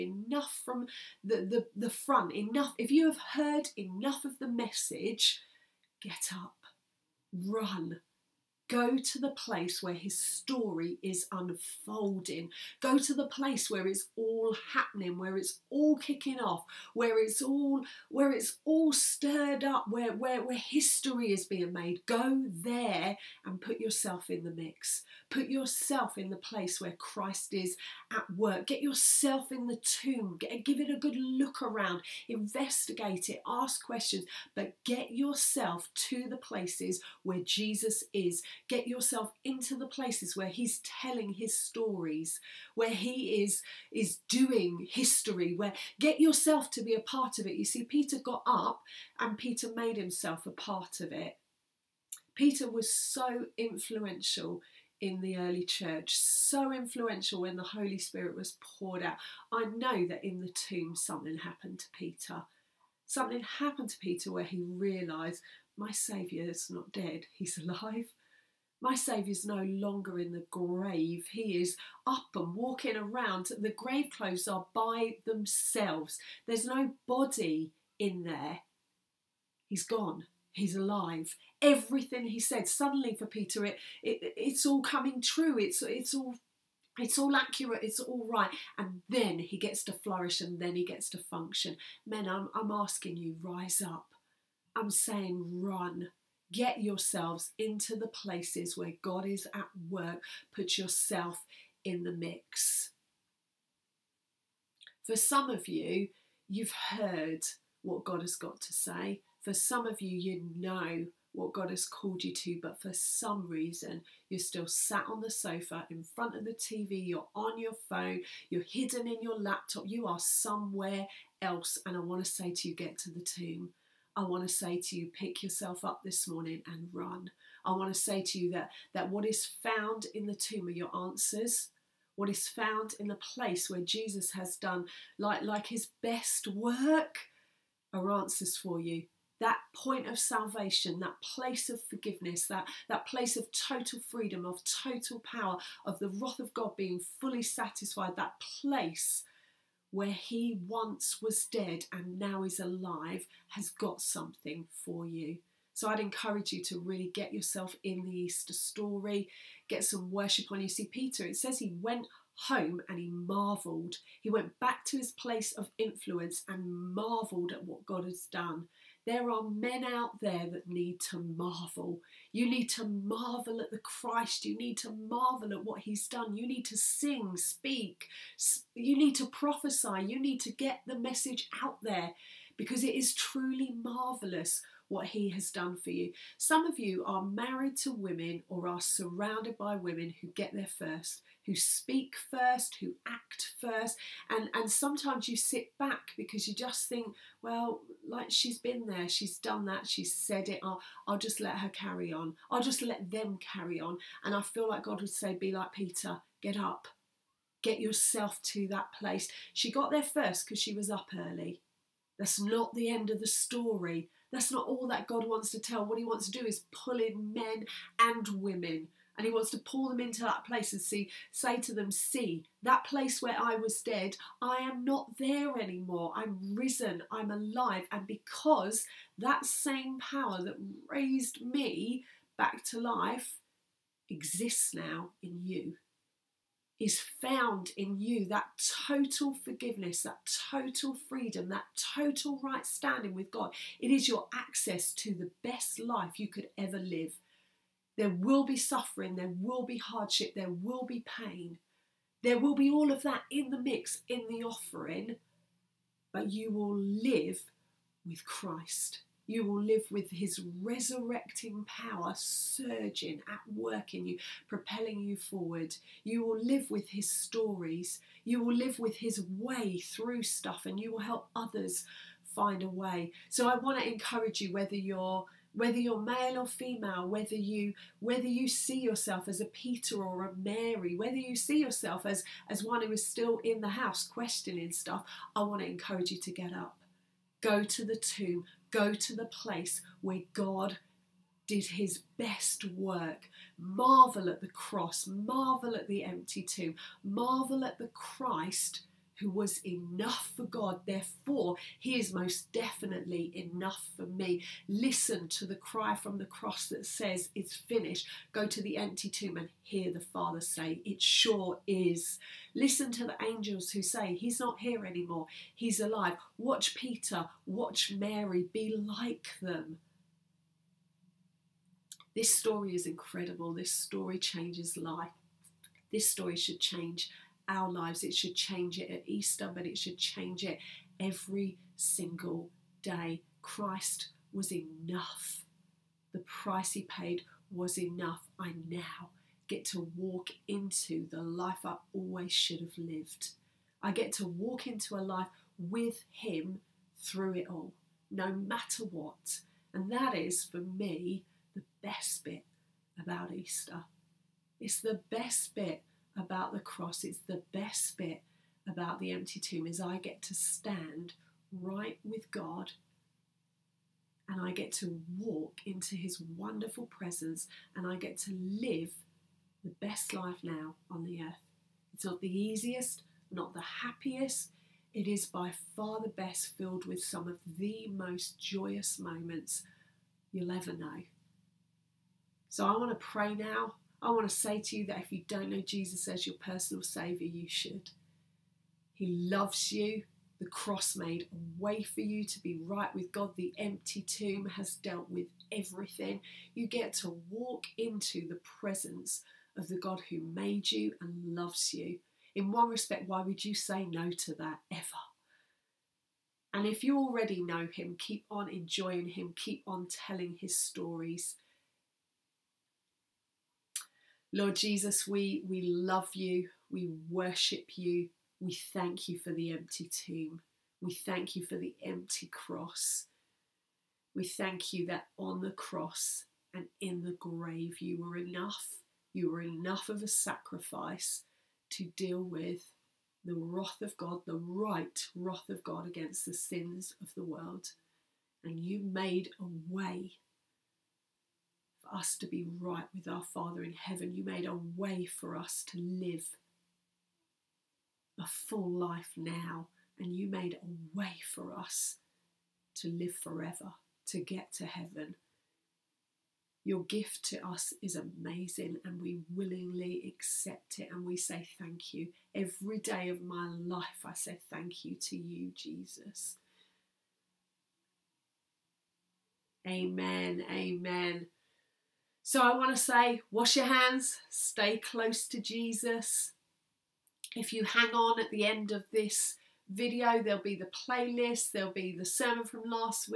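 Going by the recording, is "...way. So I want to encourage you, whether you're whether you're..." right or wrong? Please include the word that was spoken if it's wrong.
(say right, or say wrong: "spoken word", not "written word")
right.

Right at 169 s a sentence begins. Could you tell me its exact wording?
There are men out there that need to marvel.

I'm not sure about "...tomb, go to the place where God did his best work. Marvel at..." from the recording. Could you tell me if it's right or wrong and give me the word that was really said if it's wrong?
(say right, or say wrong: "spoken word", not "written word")
right.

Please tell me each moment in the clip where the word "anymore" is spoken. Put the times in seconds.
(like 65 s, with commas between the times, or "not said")
225 s, 314 s.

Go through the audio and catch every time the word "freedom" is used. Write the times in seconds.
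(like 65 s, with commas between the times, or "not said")
144 s, 241 s.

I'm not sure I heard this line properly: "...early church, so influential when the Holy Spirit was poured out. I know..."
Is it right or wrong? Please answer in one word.
right.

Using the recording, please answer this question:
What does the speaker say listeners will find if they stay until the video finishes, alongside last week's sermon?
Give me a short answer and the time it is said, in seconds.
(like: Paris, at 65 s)
the playlist, at 480 s.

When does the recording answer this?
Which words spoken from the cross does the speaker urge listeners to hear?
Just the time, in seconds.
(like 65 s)
307 s.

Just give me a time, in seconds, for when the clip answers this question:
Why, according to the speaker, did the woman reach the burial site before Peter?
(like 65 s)
210 s.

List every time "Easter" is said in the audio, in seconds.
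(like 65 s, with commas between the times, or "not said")
158 s, 329 s, 353 s.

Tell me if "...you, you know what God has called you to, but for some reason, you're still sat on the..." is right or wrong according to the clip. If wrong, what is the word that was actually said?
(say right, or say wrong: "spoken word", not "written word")
right.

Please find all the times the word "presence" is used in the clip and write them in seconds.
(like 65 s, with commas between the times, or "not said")
366 s, 398 s.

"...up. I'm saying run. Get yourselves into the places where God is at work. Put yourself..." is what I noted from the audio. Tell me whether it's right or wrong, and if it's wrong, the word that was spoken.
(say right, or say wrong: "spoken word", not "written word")
right.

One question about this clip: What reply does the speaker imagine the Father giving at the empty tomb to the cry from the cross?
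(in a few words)
It sure is.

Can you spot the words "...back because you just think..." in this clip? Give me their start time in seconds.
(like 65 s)
195 s.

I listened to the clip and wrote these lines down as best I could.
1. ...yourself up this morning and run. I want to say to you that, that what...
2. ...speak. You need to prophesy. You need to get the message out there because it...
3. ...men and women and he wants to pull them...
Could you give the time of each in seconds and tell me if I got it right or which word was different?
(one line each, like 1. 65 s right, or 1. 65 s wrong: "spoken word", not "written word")
1. 125 s right
2. 177 s right
3. 217 s right.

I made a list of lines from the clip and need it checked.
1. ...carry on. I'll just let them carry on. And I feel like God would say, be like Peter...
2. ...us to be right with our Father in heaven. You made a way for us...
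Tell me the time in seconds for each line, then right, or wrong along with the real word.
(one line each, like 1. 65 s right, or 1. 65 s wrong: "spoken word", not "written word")
1. 201 s right
2. 441 s right.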